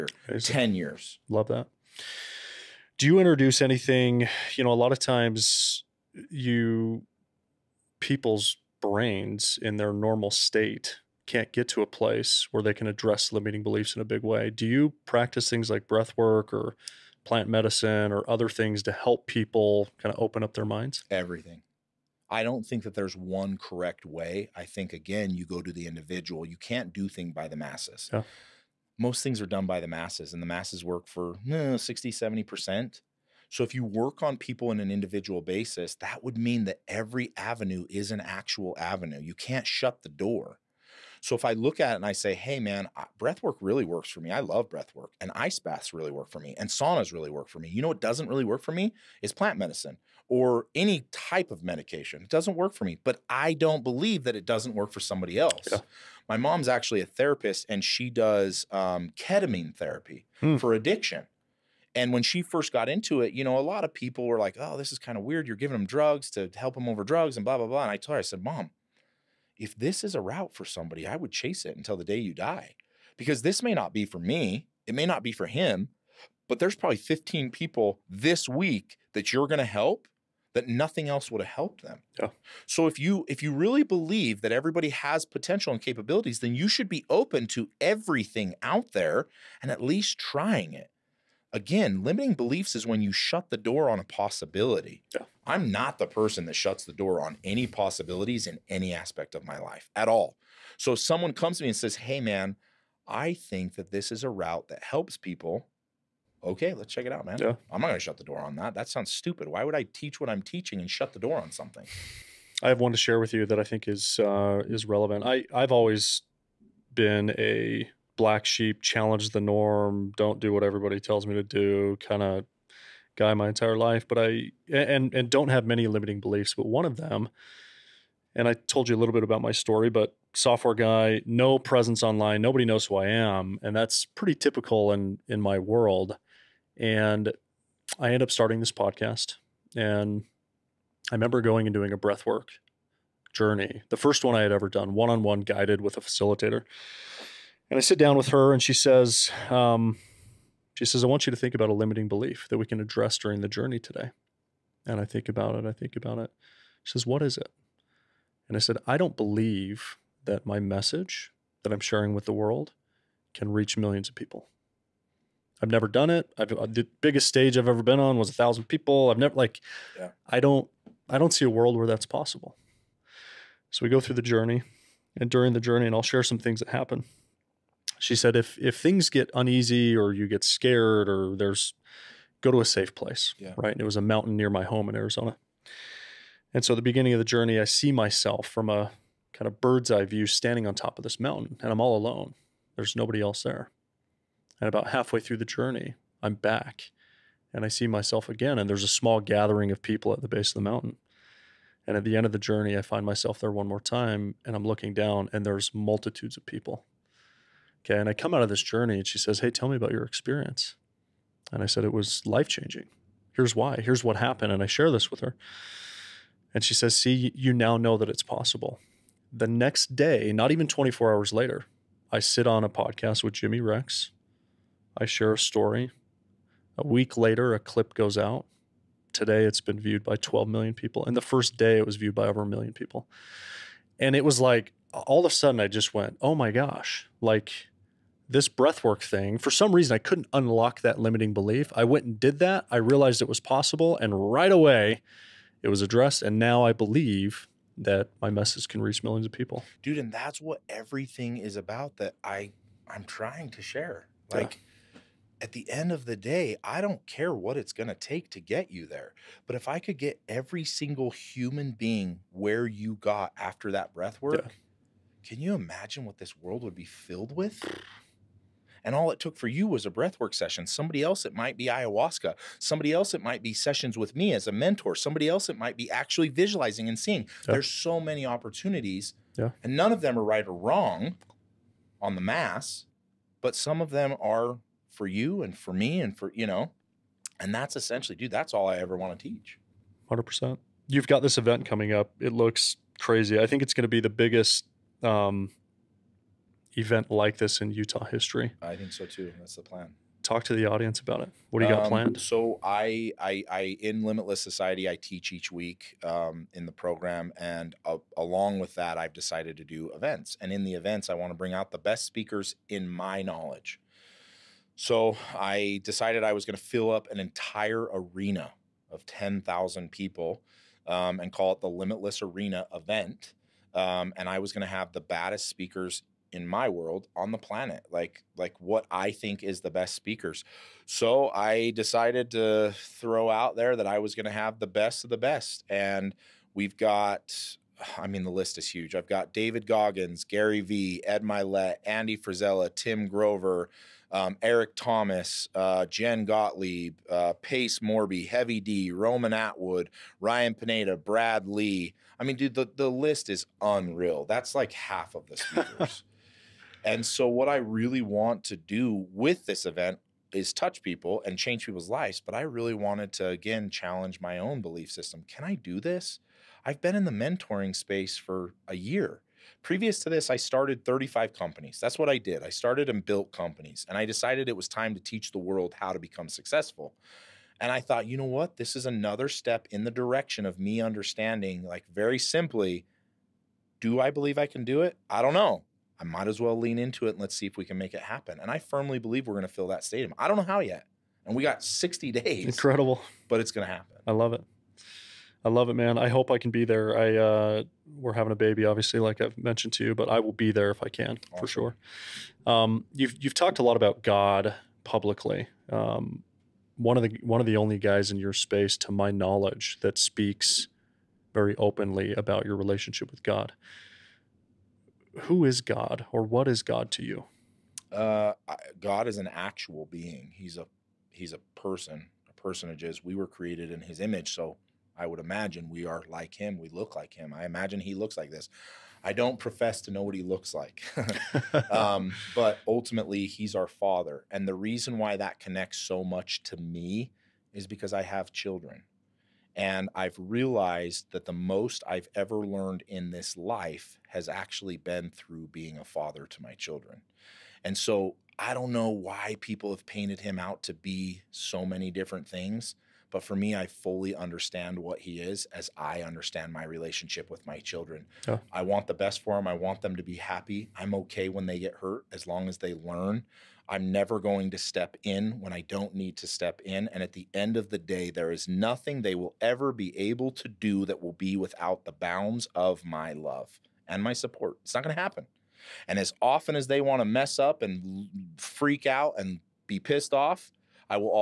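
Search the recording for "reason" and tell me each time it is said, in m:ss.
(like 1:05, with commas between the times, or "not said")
3:59, 7:14.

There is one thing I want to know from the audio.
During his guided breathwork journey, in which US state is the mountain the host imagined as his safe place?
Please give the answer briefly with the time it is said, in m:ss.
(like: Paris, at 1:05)
Arizona, at 3:05.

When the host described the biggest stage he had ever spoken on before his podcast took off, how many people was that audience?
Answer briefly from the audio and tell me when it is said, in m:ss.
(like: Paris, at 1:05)
1000, at 2:48.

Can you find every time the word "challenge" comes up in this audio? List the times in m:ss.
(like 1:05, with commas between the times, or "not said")
1:58, 6:03.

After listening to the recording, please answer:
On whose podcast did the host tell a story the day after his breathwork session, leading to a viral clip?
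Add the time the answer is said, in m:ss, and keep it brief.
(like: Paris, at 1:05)
Jimmy Rex, at 3:43.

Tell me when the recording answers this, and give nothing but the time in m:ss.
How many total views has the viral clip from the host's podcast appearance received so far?
3:50.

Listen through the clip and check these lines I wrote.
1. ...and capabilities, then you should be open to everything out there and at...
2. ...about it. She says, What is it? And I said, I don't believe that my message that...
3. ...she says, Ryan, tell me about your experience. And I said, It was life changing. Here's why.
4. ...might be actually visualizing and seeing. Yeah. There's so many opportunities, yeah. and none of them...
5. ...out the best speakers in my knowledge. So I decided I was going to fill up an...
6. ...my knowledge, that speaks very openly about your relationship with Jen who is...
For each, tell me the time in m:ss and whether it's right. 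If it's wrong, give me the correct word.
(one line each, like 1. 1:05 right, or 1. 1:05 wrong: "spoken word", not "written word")
1. 1:25 right
2. 2:35 right
3. 3:29 wrong: "Hey", not "Ryan"
4. 4:35 right
5. 5:11 right
6. 6:48 wrong: "God", not "Jen".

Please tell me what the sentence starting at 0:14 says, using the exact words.
Do you practice things like breath work or plant medicine or other things to help people kind of open up their minds?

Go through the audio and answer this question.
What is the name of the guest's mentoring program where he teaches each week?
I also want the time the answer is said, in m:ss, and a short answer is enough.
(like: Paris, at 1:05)
Limitless Society, at 5:04.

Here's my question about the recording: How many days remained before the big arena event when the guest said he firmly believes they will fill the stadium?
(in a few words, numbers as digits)
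60.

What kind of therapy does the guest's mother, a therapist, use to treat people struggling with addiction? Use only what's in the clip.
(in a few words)
ketamine therapy.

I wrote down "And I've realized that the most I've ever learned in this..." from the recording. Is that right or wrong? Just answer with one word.
right.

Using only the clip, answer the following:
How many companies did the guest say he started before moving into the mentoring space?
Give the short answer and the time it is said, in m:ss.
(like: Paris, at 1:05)
35, at 6:10.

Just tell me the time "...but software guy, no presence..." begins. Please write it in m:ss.
2:09.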